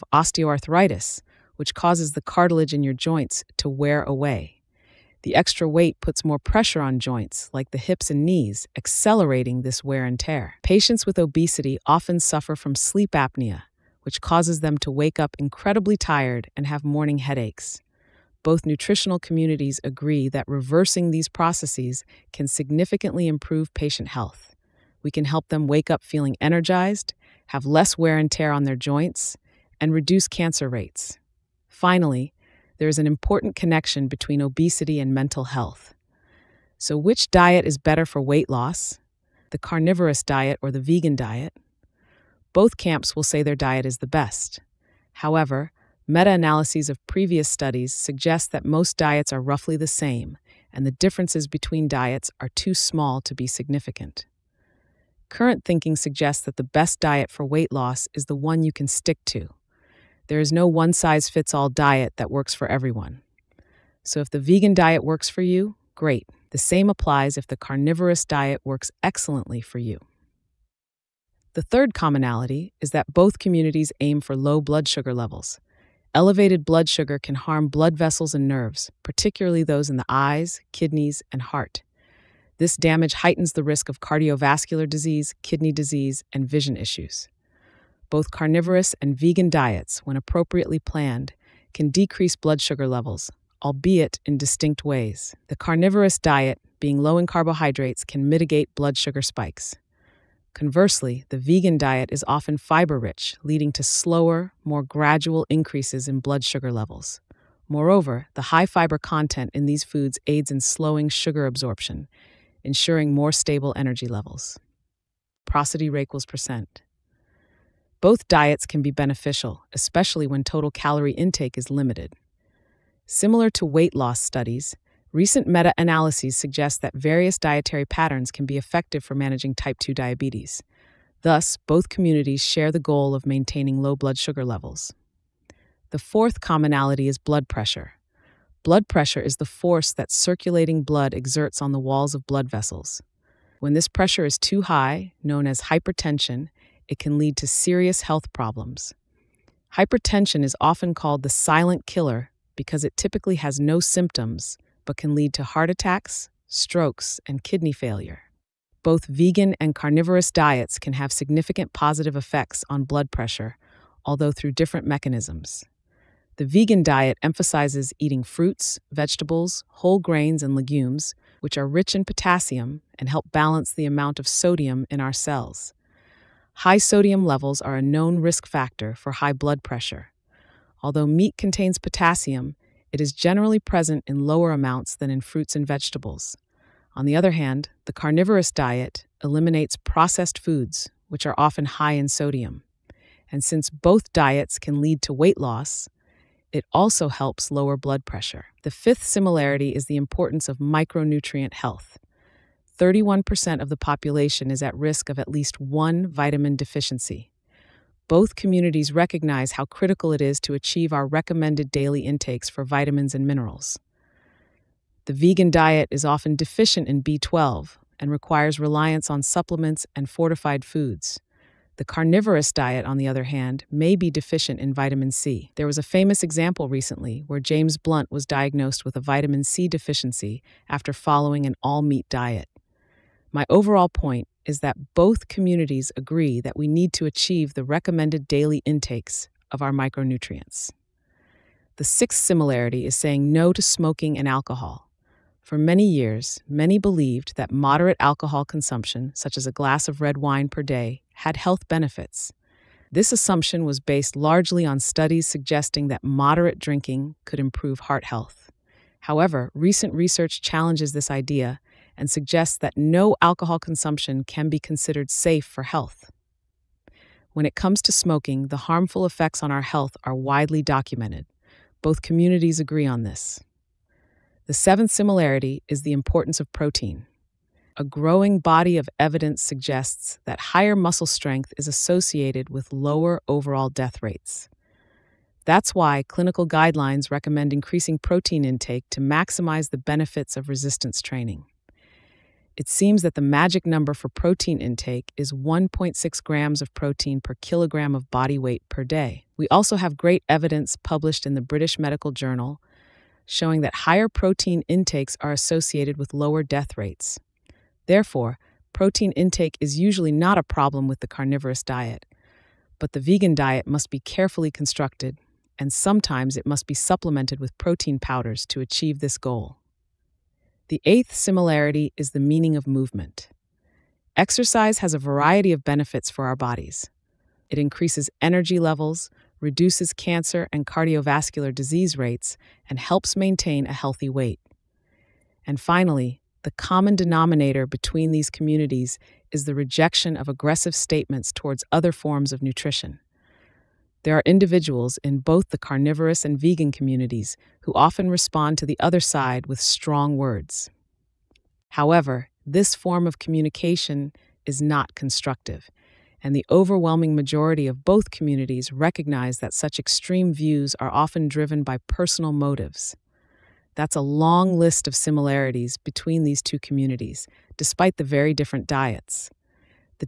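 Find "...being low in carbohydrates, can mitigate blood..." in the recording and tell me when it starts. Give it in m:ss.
1:36.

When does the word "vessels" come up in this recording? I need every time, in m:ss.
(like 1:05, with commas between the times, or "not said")
1:17, 2:22.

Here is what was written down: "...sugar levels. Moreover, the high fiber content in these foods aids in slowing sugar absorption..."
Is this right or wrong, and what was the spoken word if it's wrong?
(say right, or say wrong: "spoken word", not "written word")
right.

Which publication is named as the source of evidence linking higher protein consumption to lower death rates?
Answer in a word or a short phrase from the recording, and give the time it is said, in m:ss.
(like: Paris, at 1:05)
British Medical Journal, at 5:01.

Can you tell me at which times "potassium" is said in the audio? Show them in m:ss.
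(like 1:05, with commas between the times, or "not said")
2:52, 3:01.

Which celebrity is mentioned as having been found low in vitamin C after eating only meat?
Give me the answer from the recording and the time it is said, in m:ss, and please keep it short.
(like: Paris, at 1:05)
James Blunt, at 3:47.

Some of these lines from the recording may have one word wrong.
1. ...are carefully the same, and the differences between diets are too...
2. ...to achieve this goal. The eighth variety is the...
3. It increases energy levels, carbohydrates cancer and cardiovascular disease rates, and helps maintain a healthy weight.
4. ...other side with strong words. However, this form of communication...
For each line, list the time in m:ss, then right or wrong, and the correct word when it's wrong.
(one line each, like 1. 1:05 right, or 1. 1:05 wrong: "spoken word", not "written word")
1. 0:49 wrong: "roughly", not "carefully"
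2. 5:18 wrong: "similarity", not "variety"
3. 5:27 wrong: "reduces", not "carbohydrates"
4. 5:48 right.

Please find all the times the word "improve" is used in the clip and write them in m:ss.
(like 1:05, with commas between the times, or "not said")
0:23, 4:17.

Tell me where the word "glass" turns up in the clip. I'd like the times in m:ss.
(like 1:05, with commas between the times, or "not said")
4:09.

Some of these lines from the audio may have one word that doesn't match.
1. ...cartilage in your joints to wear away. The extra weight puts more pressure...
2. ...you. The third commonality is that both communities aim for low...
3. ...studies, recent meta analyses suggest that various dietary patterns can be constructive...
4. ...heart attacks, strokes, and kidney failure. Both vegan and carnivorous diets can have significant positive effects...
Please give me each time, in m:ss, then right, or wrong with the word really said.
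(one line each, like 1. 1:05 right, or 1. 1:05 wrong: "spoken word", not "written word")
1. 0:02 right
2. 1:09 right
3. 2:04 wrong: "effective", not "constructive"
4. 2:35 right.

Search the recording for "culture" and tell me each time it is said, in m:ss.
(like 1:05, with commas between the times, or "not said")
not said.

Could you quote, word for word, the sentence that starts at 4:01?
The sixth similarity is saying no to smoking and alcohol.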